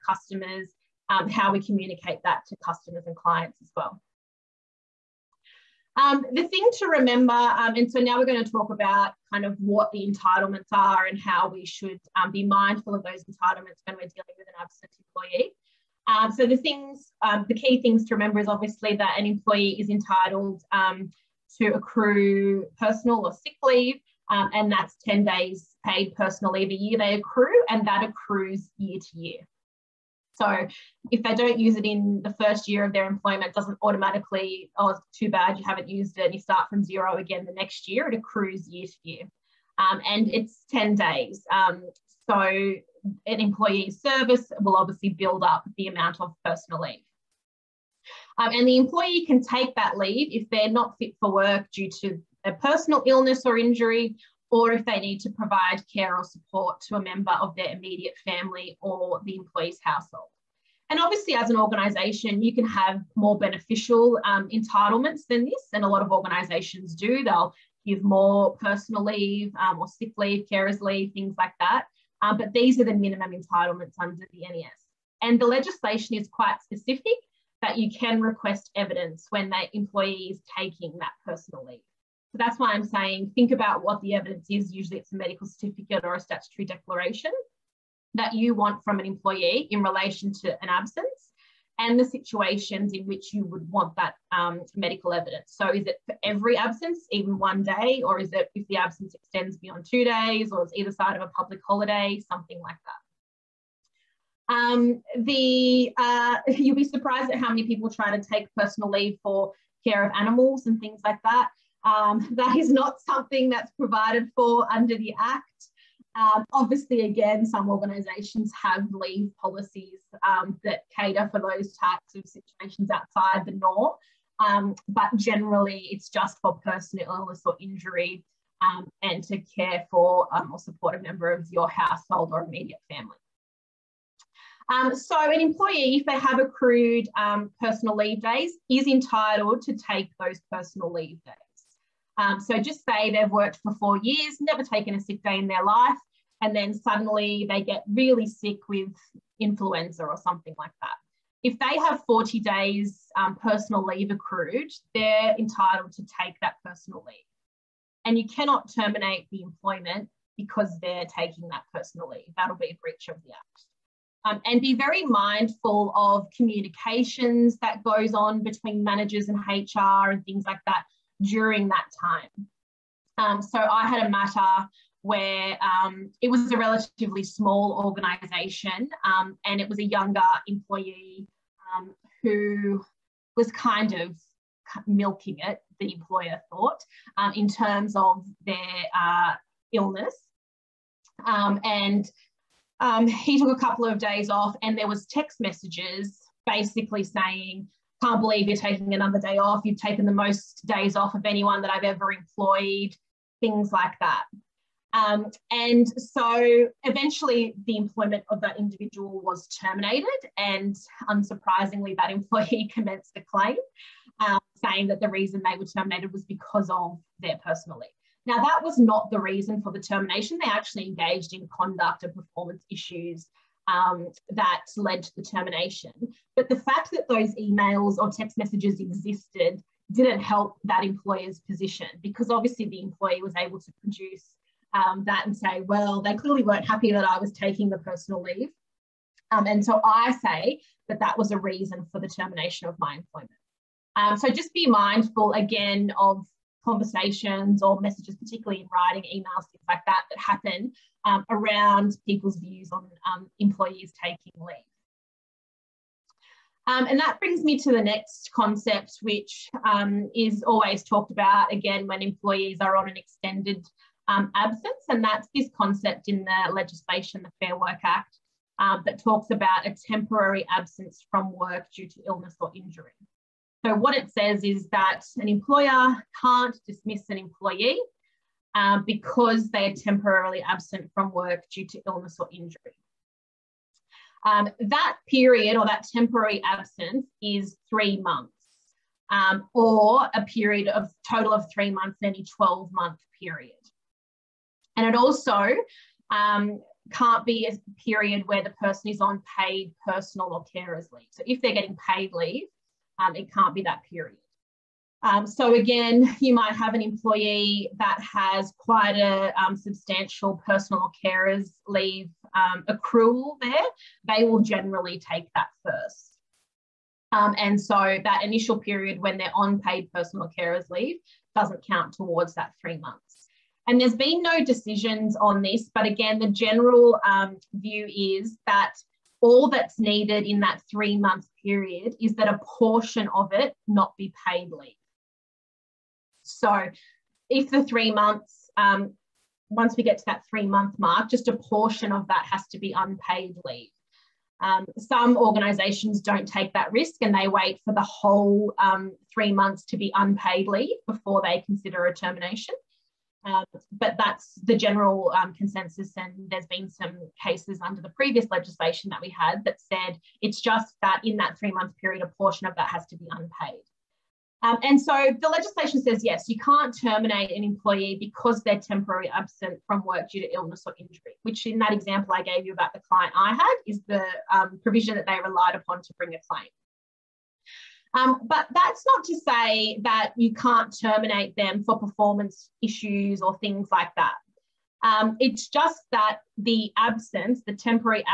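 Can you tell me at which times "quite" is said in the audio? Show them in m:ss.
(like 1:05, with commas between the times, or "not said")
1:16, 5:08.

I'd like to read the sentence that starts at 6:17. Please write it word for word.
Um, but that's not to say that you can't terminate them for performance issues or things like that.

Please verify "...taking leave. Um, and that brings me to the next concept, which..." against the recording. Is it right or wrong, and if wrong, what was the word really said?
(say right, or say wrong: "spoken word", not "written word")
right.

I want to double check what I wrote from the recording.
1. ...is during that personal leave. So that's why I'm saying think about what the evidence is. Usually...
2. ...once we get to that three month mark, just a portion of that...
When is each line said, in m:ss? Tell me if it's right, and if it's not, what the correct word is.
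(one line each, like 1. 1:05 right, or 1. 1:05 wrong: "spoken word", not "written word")
1. 1:20 wrong: "taking", not "during"
2. 5:39 right.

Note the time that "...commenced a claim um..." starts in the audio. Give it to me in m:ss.
3:32.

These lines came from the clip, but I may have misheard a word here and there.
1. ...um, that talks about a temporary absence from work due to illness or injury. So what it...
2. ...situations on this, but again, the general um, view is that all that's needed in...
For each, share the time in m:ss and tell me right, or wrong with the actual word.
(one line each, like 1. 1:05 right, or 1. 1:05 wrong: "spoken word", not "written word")
1. 4:28 right
2. 5:24 wrong: "decisions", not "situations".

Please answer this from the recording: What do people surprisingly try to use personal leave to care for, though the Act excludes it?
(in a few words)
animals.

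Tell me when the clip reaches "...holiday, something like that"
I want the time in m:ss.
1:41.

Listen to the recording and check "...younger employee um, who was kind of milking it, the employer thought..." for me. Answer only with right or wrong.
right.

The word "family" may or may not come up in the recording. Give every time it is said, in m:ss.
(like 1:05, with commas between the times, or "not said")
0:58, 2:12.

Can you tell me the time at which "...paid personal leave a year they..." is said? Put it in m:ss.
0:25.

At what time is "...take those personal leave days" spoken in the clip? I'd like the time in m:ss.
2:19.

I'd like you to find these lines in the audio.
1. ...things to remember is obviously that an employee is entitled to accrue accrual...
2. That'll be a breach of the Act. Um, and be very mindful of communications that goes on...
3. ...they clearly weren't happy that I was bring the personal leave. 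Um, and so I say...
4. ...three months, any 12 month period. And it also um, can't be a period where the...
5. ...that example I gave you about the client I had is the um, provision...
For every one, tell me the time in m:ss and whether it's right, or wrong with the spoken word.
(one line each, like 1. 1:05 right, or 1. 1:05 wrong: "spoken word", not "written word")
1. 0:17 wrong: "personal", not "accrual"
2. 2:42 right
3. 3:56 wrong: "taking", not "bring"
4. 4:51 right
5. 6:11 right.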